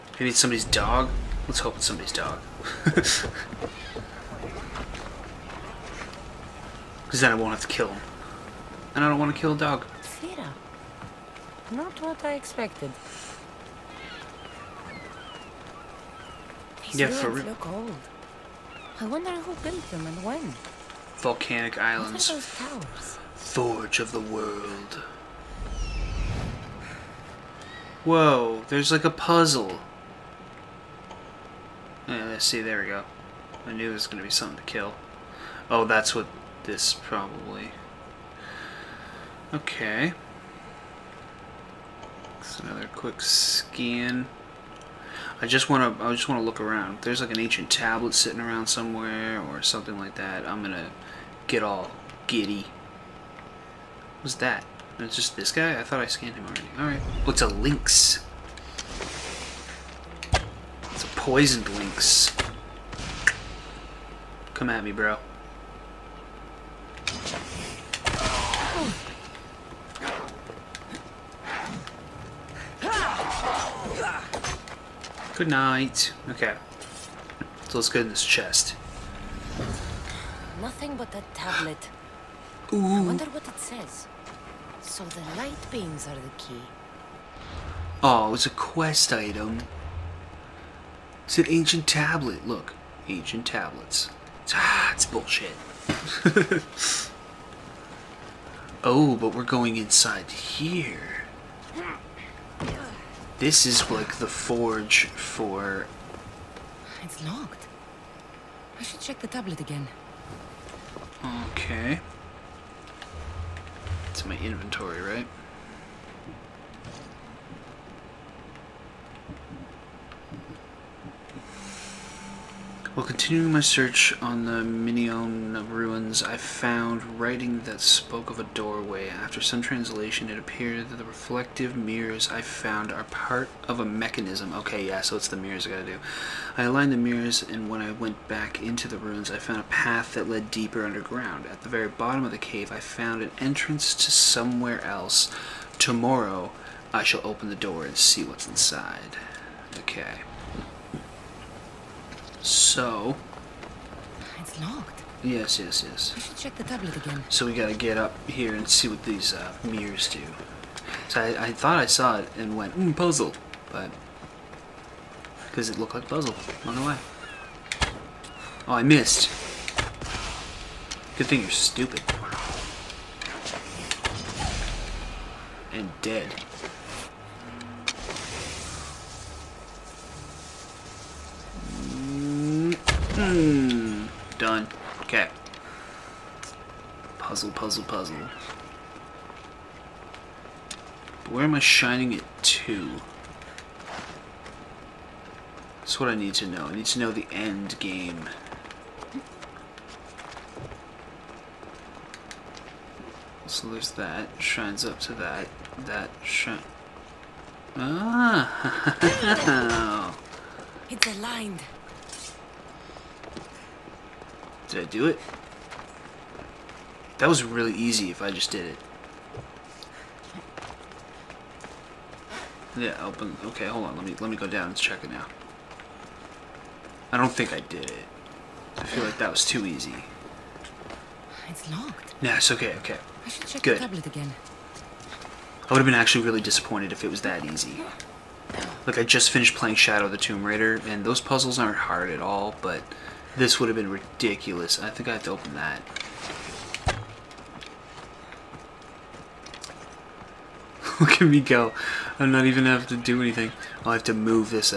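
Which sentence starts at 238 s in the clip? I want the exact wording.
Look, I just finished playing Shadow the Tomb Raider, and those puzzles aren't hard at all, but this would have been ridiculous.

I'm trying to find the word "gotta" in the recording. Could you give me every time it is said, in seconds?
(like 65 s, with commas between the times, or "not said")
135 s, 157 s.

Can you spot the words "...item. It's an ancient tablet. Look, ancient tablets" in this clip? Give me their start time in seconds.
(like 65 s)
89 s.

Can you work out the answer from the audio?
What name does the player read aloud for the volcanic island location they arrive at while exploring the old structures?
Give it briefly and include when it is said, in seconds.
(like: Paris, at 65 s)
Thera, at 10 s.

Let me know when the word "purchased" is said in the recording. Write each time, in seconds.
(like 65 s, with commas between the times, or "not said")
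not said.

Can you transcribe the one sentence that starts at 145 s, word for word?
Tomorrow, I shall open the door and see what's inside.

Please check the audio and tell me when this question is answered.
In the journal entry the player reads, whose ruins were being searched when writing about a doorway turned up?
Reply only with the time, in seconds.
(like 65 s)
124 s.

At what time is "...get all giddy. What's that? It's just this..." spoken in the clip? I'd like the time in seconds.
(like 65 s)
51 s.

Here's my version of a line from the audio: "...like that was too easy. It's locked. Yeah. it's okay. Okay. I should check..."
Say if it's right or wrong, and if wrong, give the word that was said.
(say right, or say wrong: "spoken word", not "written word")
right.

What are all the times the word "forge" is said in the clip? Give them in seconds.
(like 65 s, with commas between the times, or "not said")
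23 s, 104 s.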